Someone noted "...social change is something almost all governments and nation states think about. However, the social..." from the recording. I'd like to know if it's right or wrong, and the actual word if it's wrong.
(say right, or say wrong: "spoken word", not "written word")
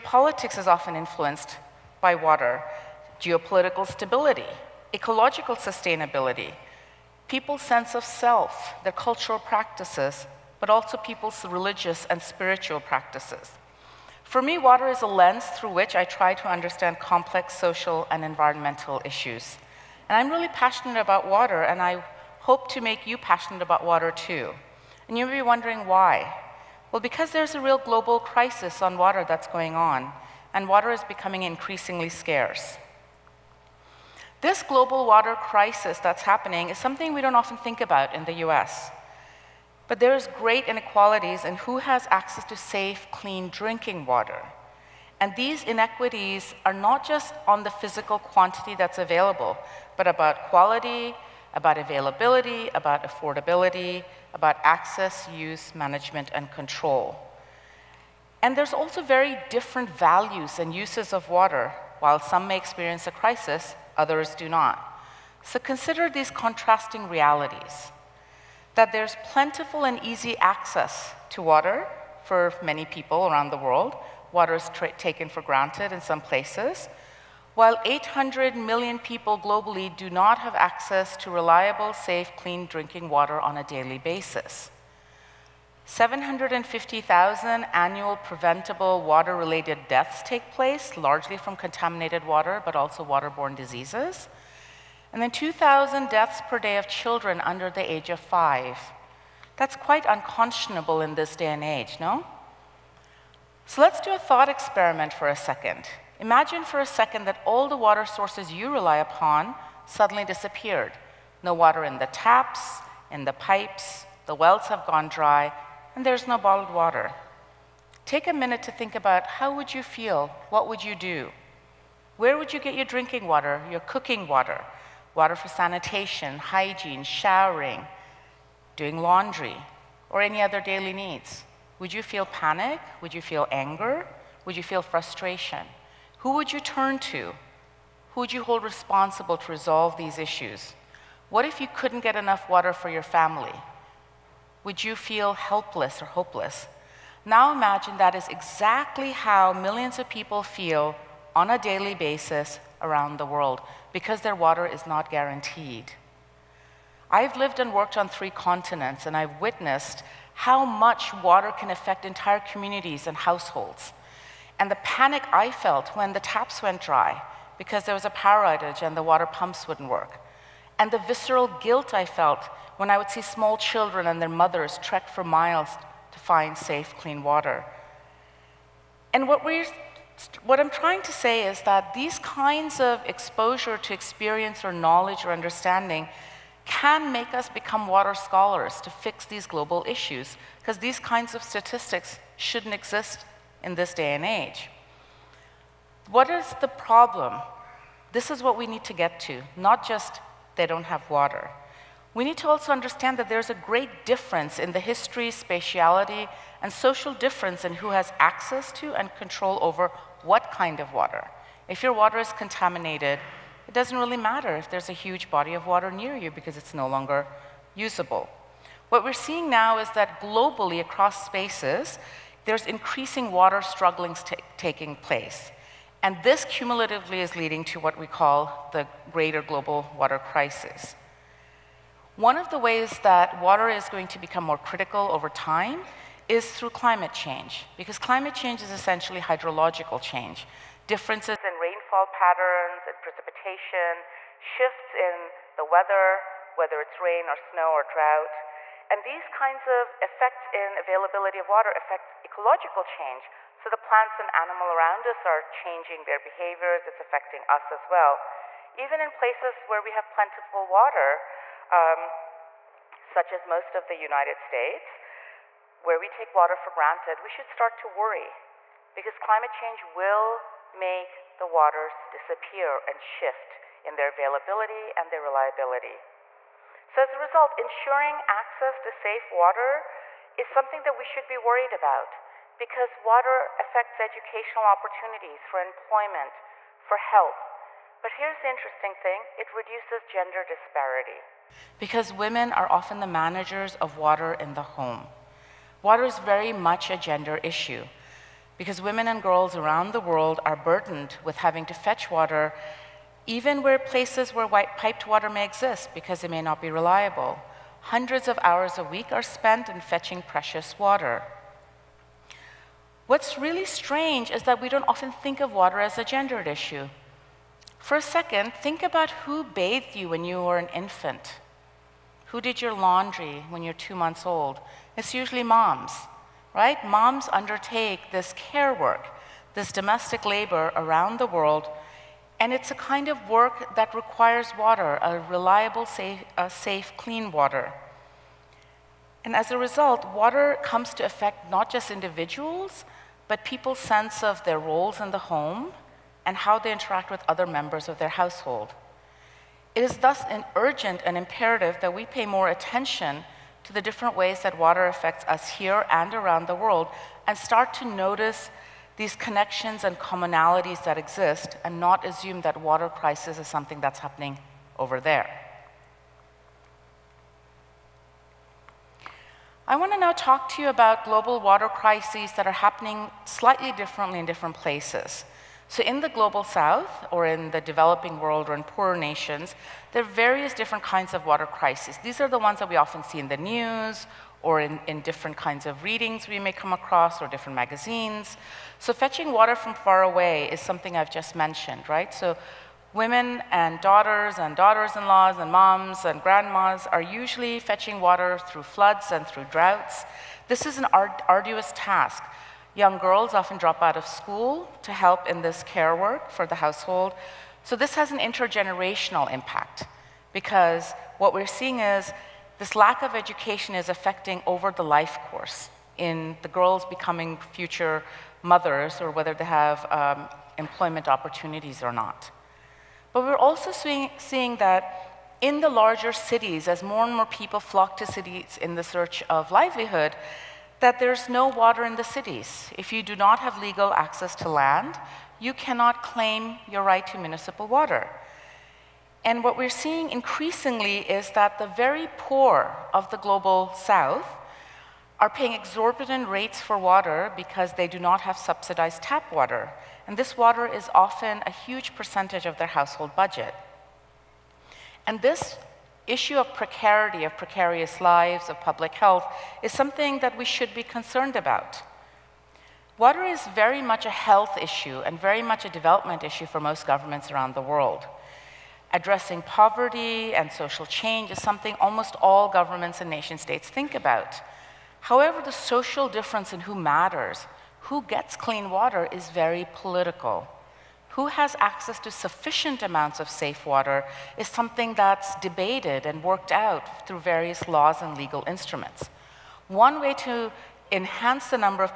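right.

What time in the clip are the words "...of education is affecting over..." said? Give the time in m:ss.
6:53.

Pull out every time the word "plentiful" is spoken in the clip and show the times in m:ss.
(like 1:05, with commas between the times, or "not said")
1:09, 4:20.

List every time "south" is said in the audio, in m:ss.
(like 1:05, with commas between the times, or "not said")
6:16, 7:23.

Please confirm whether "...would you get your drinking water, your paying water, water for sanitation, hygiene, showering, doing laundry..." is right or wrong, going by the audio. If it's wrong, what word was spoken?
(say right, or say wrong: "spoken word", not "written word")
wrong: "cooking", not "paying".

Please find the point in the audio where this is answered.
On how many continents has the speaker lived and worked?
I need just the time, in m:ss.
2:38.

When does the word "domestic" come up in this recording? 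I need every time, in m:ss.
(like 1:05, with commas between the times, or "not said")
5:29.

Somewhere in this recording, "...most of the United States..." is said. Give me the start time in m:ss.
4:23.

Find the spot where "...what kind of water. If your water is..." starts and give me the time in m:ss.
3:30.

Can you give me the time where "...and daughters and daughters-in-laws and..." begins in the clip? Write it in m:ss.
6:33.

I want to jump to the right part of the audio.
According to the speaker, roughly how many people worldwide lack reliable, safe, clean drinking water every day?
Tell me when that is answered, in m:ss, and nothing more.
1:17.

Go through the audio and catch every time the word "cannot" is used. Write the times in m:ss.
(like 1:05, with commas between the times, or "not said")
7:15.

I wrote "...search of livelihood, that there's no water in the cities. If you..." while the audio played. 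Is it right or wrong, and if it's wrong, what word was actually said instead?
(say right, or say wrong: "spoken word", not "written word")
right.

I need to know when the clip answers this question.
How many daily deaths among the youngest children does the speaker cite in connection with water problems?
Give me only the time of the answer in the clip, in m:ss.
1:35.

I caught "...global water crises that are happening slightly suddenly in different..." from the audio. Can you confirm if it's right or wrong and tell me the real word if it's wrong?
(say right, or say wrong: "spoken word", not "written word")
wrong: "differently", not "suddenly".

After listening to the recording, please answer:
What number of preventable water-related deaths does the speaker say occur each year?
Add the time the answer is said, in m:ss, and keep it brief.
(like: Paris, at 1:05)
750,000, at 1:25.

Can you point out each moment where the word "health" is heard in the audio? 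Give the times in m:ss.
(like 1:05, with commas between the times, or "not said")
4:46, 7:38, 7:44.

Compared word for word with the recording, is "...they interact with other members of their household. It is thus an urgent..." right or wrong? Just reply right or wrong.
right.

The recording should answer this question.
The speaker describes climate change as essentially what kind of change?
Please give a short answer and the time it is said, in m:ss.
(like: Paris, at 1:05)
hydrological change, at 3:59.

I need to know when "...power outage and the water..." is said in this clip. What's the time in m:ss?
2:48.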